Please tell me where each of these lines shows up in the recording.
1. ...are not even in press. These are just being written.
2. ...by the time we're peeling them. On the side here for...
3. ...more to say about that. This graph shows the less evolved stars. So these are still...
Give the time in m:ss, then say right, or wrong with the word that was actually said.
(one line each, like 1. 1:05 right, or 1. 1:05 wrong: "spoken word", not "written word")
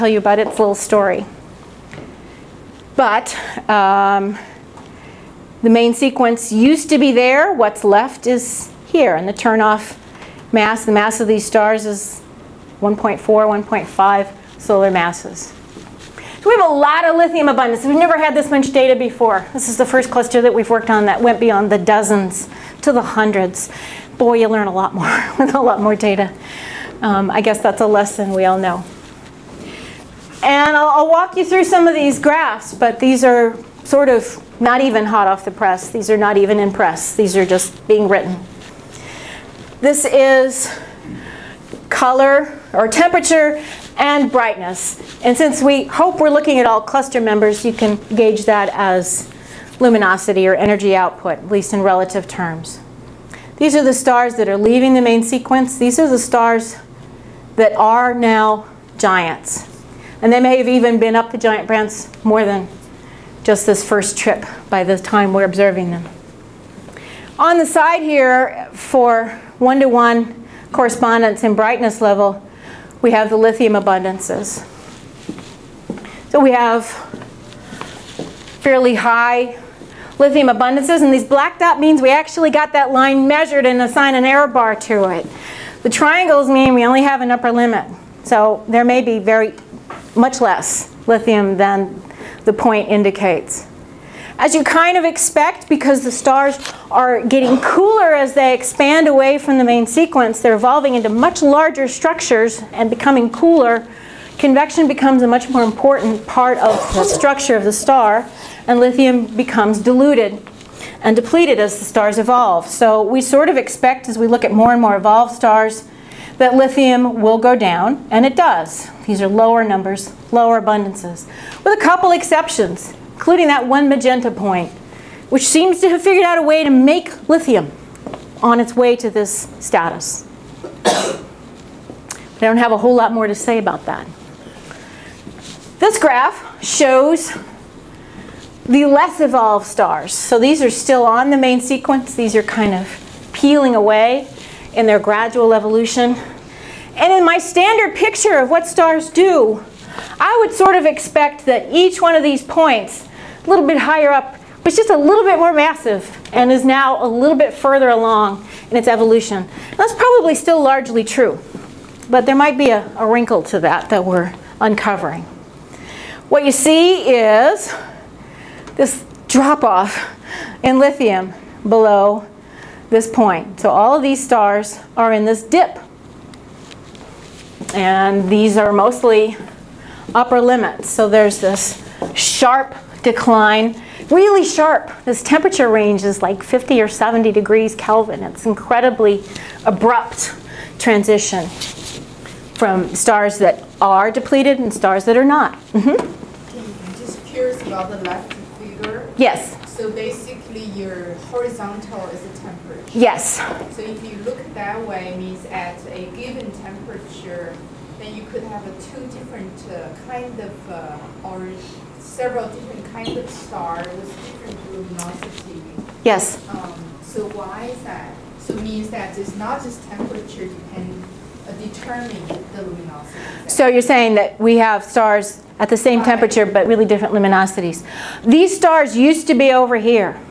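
1. 0:36 right
2. 1:04 wrong: "observing", not "peeling"
3. 2:13 right.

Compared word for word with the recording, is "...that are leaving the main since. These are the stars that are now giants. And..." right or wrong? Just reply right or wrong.
wrong.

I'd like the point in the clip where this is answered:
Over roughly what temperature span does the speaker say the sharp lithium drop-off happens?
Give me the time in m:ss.
3:06.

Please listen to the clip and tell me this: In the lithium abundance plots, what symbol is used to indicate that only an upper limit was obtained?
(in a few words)
Triangles.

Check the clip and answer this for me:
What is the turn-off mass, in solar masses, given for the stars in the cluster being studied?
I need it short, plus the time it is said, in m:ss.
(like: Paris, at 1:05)
1.4 to 1.5 solar masses, at 0:12.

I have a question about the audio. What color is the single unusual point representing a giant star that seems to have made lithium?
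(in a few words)
Magenta.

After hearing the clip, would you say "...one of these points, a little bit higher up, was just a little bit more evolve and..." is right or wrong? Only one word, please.
wrong.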